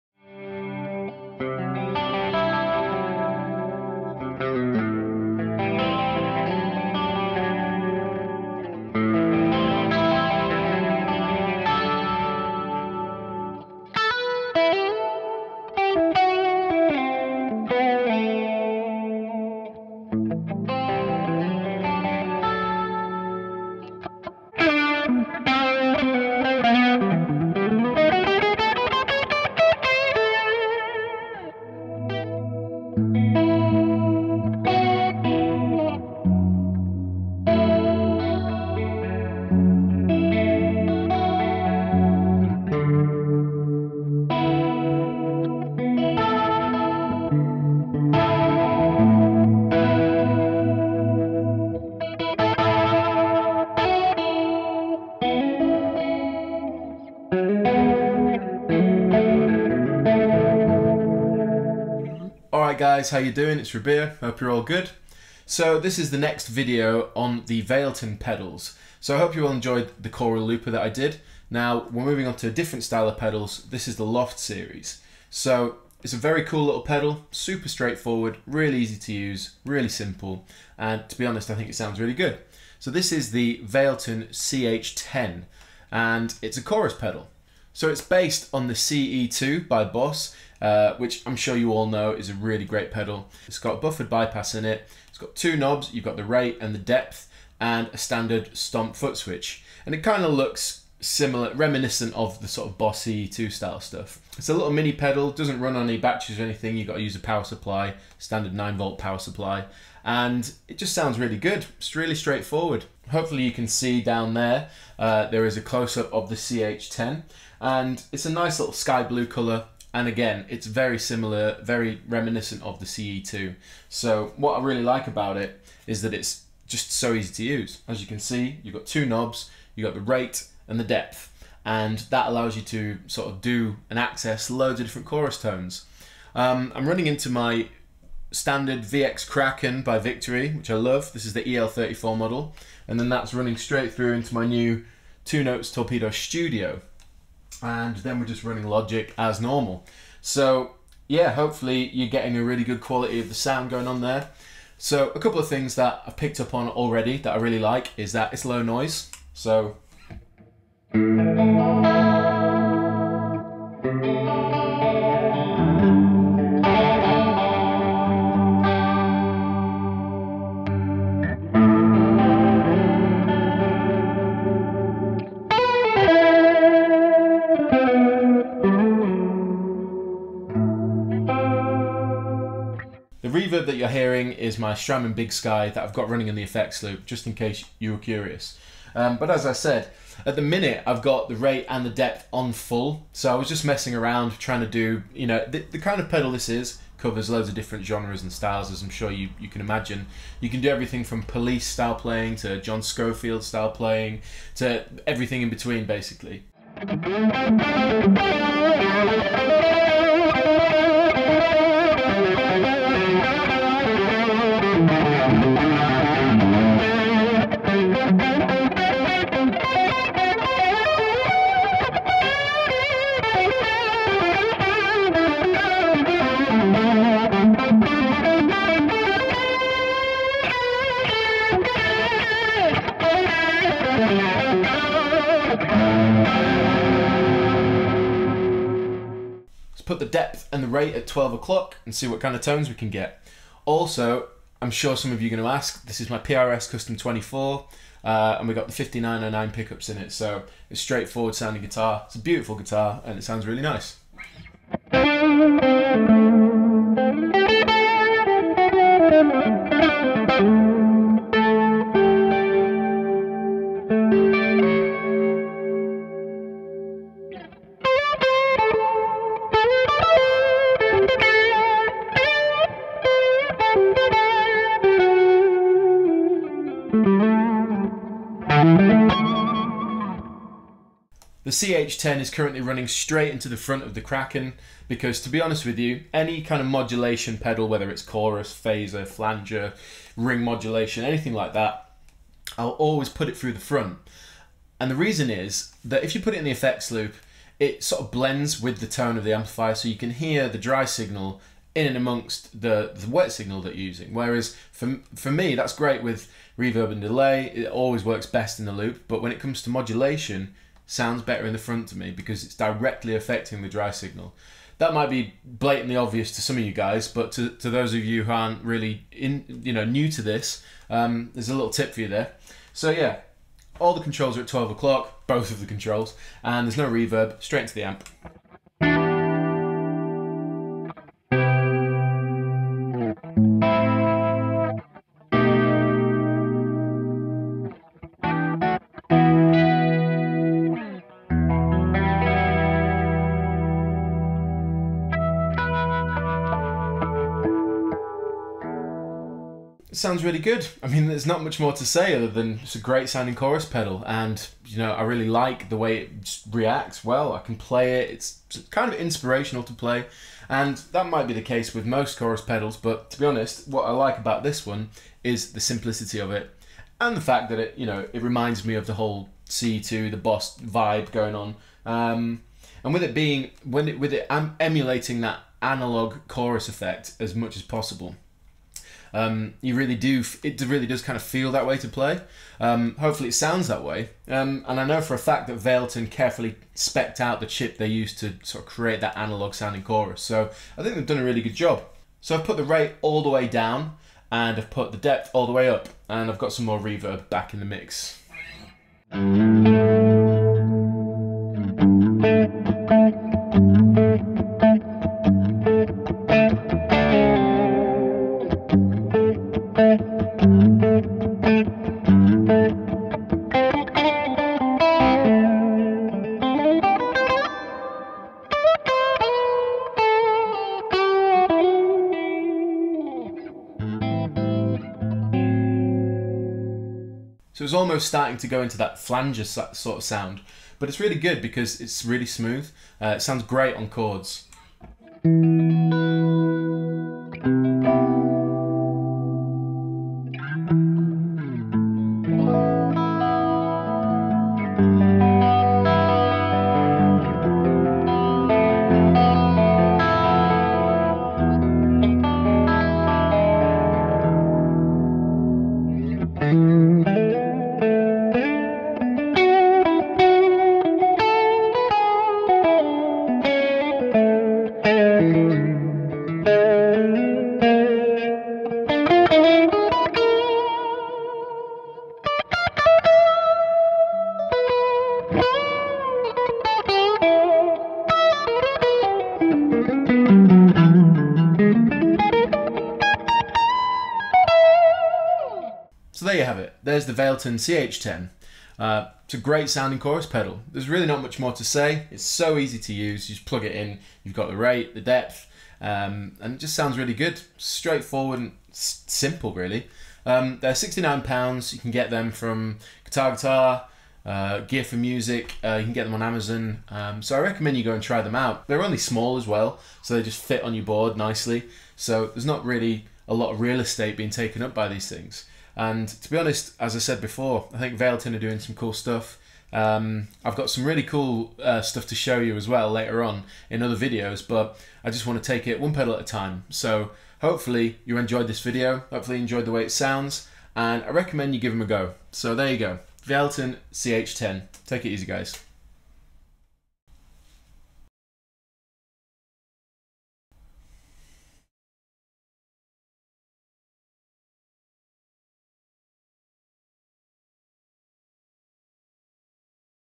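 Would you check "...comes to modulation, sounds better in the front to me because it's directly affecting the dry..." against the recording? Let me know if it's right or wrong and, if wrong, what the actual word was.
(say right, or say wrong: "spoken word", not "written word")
right.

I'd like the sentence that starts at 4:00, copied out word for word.
depth and the rate at 12 o'clock and see what kind of tones we can get.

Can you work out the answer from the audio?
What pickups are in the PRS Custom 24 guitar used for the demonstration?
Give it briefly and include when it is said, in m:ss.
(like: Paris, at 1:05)
5909, at 4:08.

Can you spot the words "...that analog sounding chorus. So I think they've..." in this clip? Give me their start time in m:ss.
6:29.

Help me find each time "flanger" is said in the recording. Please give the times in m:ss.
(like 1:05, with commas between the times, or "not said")
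4:49, 7:08.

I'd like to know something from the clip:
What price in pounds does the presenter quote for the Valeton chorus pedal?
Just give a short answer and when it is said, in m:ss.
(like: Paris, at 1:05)
£69, at 8:20.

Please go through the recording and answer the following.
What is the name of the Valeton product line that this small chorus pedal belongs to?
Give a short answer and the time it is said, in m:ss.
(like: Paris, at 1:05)
Loft series, at 1:14.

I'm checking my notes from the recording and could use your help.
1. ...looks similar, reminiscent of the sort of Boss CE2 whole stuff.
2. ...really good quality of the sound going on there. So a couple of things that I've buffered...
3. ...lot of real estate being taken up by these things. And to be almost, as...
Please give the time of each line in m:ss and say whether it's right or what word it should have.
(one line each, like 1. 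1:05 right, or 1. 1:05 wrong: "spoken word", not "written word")
1. 1:40 wrong: "style", not "whole"
2. 2:32 wrong: "picked", not "buffered"
3. 8:33 wrong: "honest", not "almost".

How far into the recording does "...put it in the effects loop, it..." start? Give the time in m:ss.
4:56.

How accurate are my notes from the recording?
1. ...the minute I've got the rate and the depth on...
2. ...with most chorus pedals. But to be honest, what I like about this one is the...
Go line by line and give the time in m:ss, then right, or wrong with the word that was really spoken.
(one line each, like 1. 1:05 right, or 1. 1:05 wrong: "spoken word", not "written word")
1. 3:10 right
2. 6:01 right.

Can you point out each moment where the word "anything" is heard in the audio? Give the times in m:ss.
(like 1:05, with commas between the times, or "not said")
1:46, 4:51.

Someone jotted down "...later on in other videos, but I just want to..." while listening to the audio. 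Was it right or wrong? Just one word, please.
right.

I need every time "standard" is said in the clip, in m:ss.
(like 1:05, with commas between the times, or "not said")
1:37, 1:48, 2:18.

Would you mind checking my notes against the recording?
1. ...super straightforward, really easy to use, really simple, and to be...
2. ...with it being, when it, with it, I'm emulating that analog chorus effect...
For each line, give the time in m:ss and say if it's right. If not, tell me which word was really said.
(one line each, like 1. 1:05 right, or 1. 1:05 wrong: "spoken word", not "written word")
1. 1:17 right
2. 6:12 right.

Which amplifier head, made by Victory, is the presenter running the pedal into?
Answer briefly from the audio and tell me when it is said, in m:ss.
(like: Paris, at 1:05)
VX Kraken, at 2:18.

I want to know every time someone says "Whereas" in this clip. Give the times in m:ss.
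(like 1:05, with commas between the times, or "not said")
5:04.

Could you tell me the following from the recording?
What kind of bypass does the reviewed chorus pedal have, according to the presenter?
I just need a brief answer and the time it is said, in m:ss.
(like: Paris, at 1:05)
Buffered bypass, at 1:33.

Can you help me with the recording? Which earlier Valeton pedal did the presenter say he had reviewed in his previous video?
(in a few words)
Coral Looper.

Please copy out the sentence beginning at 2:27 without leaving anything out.
And then we're just running Logic as normal.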